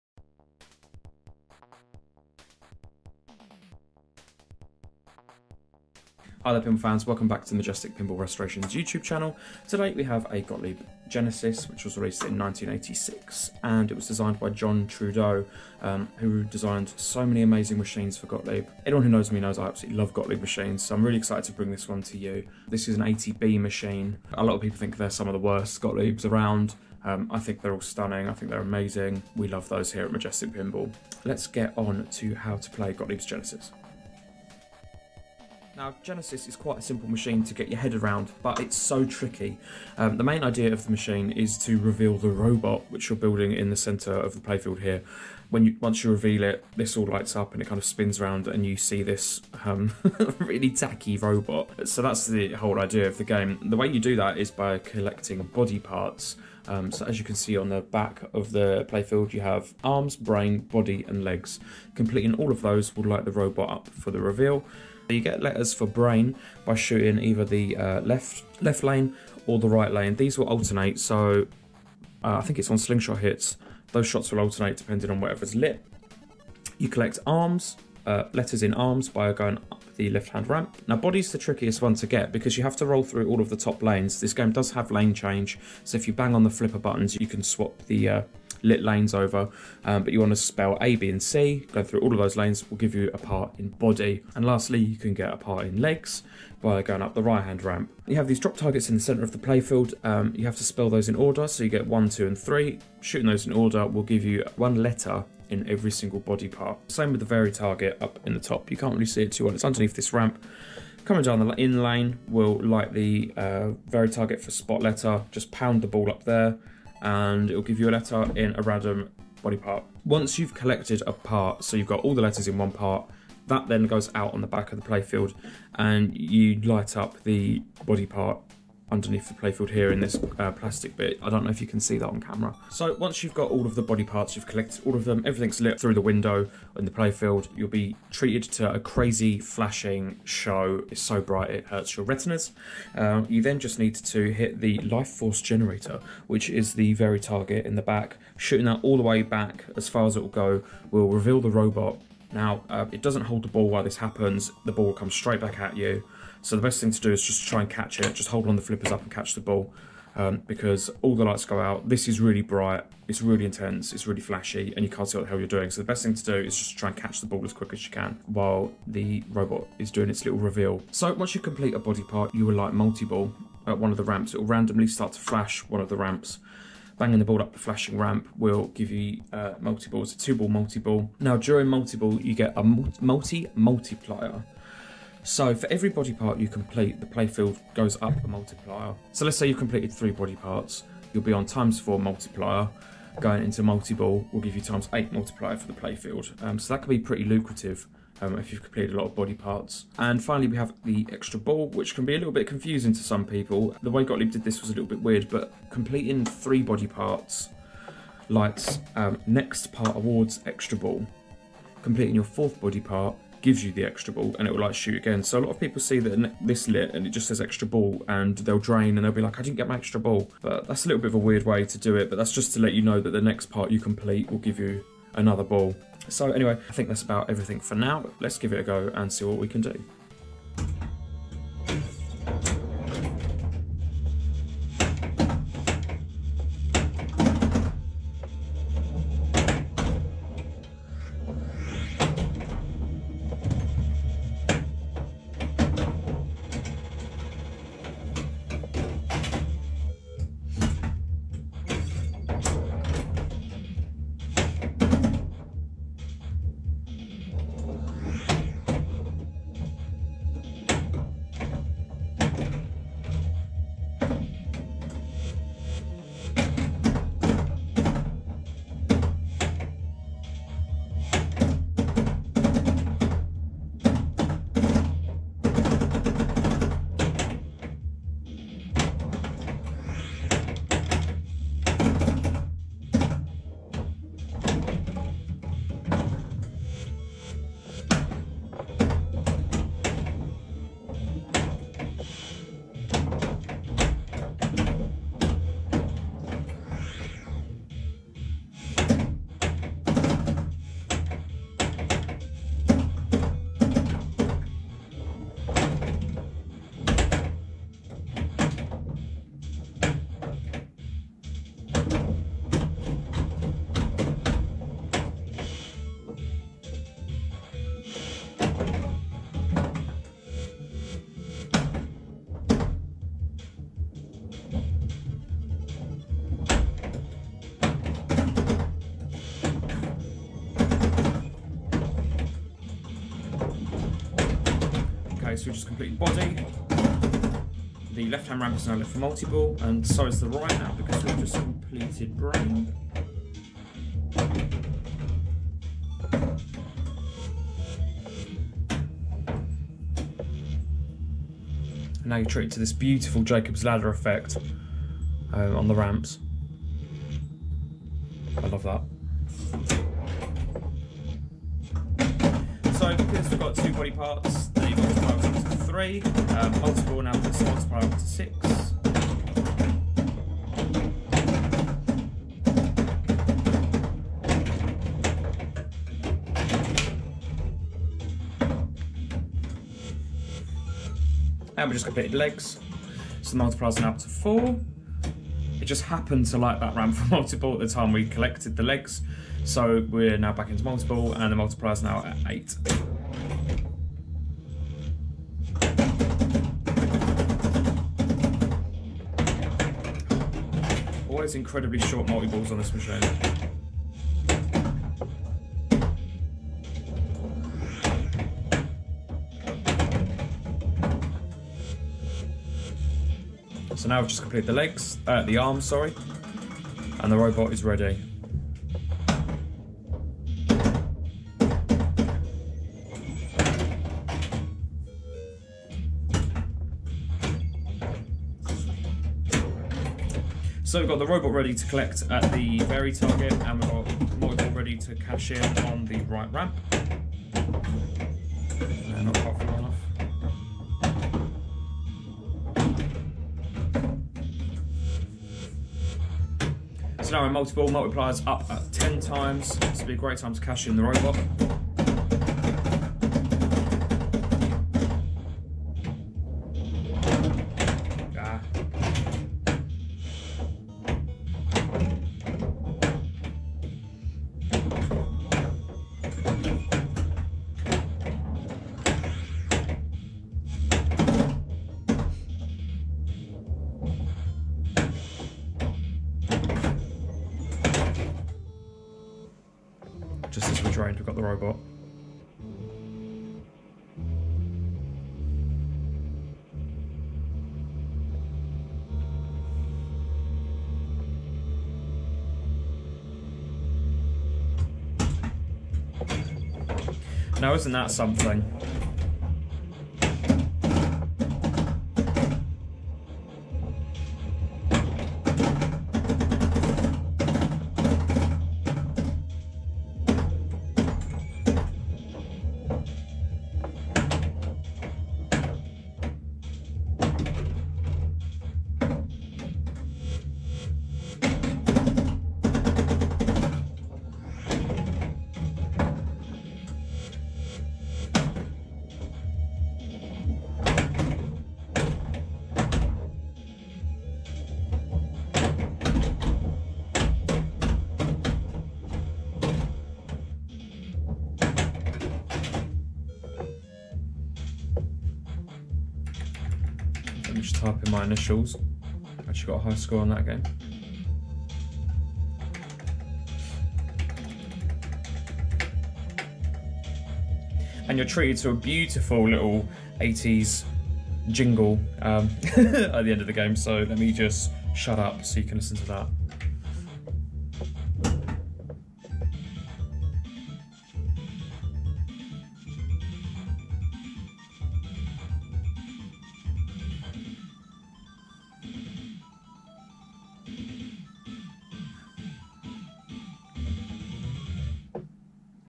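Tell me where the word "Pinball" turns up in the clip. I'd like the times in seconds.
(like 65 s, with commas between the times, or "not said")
7 s, 30 s.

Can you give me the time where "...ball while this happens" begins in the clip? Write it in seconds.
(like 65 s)
153 s.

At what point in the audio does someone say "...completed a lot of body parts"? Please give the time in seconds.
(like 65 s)
198 s.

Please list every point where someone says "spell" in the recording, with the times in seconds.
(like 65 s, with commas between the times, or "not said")
90 s, 100 s.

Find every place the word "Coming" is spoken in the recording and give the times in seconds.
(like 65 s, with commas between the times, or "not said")
111 s.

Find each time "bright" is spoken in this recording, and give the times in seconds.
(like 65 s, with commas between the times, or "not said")
141 s, 162 s.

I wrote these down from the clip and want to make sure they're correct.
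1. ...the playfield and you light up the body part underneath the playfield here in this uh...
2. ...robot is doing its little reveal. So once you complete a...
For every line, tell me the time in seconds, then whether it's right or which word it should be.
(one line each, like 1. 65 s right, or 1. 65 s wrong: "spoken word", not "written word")
1. 124 s right
2. 169 s right.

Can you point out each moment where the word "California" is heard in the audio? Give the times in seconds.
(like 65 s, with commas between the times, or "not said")
not said.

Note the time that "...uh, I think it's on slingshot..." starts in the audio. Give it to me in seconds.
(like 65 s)
72 s.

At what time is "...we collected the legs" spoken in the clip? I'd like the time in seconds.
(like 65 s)
387 s.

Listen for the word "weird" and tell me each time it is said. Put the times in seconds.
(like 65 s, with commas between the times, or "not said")
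205 s, 221 s.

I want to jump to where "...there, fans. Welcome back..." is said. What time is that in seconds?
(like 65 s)
6 s.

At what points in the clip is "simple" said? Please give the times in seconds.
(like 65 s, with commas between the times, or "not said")
36 s.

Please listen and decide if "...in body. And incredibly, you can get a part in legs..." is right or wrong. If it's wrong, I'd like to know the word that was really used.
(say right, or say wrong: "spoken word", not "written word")
wrong: "lastly", not "incredibly".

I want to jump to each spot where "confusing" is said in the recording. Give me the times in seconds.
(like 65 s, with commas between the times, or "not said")
202 s.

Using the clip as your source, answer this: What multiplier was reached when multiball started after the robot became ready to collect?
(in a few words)
10.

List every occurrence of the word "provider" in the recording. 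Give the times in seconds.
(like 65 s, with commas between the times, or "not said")
not said.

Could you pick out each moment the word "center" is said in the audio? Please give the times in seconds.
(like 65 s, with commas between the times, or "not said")
43 s, 99 s.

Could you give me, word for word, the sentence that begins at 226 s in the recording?
So anyway, I think that's about everything for now.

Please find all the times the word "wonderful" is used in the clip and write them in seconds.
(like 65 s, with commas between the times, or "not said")
not said.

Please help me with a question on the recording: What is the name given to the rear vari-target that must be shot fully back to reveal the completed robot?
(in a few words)
life force generator.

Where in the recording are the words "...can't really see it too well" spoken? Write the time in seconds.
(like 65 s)
108 s.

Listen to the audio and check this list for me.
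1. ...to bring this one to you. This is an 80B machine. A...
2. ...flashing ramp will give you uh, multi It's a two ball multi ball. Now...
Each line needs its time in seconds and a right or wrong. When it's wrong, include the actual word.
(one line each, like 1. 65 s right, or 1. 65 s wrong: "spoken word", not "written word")
1. 21 s right
2. 177 s right.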